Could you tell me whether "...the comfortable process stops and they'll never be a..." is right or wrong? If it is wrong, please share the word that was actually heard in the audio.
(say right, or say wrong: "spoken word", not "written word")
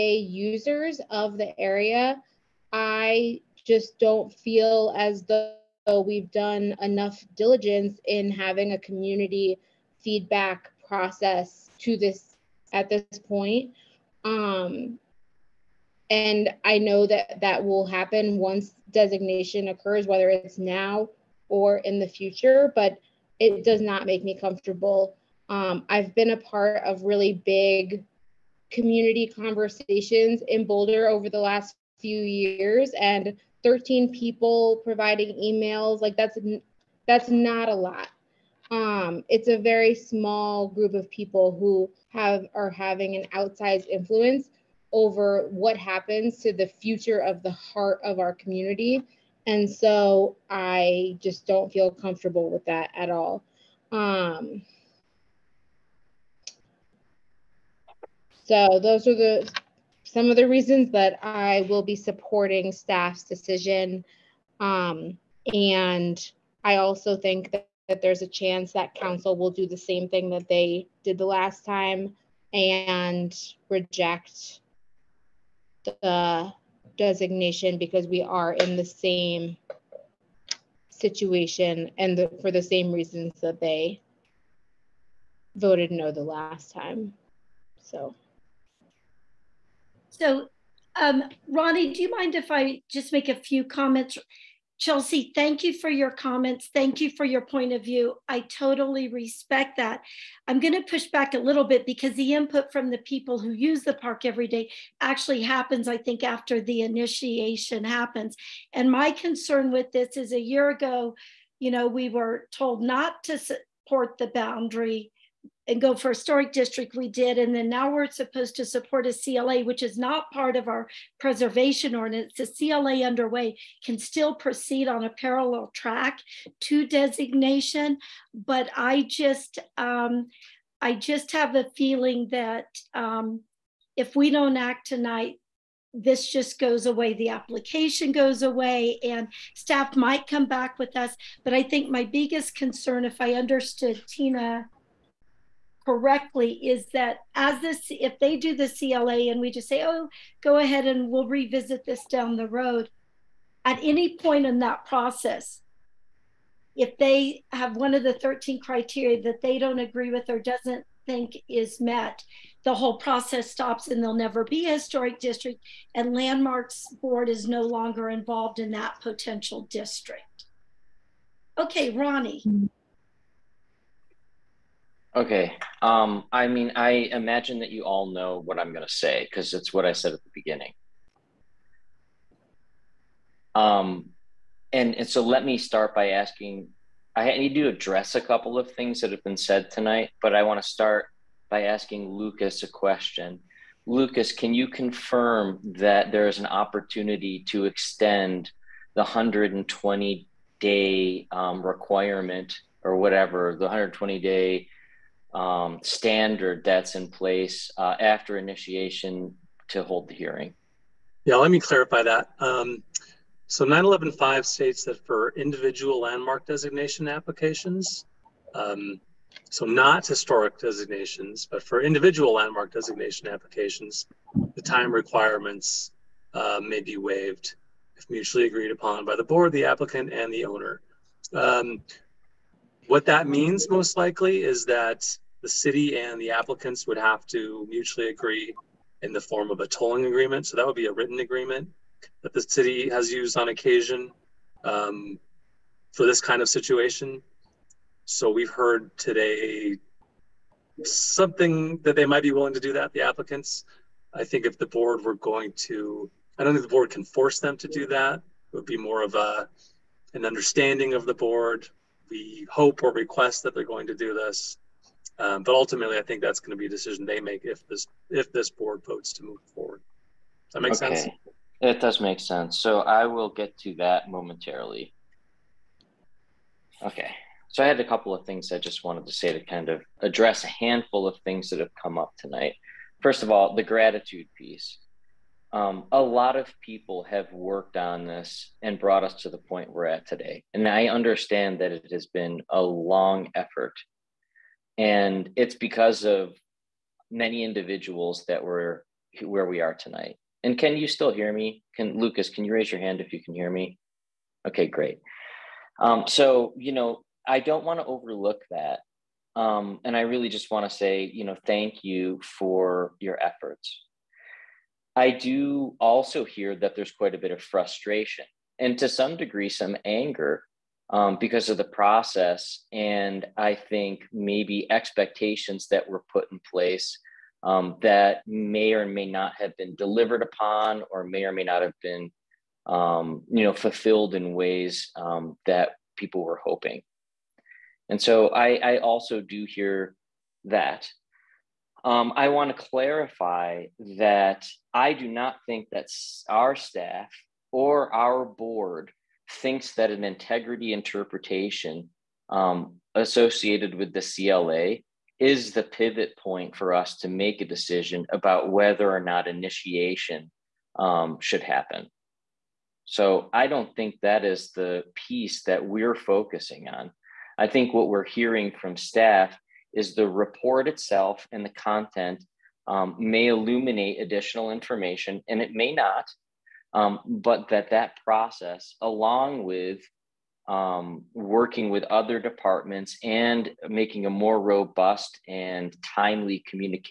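wrong: "whole", not "comfortable".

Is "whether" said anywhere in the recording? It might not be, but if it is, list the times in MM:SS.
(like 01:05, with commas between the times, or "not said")
00:20, 05:58.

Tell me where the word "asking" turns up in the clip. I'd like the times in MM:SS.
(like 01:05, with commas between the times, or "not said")
03:06, 03:11.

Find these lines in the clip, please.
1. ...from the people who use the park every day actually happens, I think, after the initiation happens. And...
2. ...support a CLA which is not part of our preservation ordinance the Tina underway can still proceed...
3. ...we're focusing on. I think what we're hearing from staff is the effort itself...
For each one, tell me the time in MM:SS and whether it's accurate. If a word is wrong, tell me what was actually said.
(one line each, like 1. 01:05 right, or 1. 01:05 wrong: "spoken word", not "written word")
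1. 01:42 right
2. 01:58 wrong: "CLA", not "Tina"
3. 06:05 wrong: "report", not "effort".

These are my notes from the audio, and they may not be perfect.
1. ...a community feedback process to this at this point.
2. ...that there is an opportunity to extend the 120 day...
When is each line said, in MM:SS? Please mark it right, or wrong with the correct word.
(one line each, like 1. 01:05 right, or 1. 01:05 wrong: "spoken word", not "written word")
1. 00:08 right
2. 03:15 right.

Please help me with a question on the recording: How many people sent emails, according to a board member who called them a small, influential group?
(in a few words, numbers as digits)
13.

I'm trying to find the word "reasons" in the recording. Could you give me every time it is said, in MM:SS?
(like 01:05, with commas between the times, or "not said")
01:00, 01:22.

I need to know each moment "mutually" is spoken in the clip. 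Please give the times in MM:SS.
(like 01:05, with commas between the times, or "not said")
03:48, 03:57.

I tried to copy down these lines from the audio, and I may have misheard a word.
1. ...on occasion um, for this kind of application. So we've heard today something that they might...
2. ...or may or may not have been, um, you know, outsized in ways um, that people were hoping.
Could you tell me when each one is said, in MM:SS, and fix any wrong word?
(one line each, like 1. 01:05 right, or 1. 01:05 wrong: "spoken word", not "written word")
1. 04:03 wrong: "situation", not "application"
2. 05:30 wrong: "fulfilled", not "outsized".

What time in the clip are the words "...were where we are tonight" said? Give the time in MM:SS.
04:58.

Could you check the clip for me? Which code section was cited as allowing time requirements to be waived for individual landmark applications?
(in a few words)
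9-11-5.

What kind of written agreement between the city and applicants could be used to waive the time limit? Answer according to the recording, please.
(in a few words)
tolling agreement.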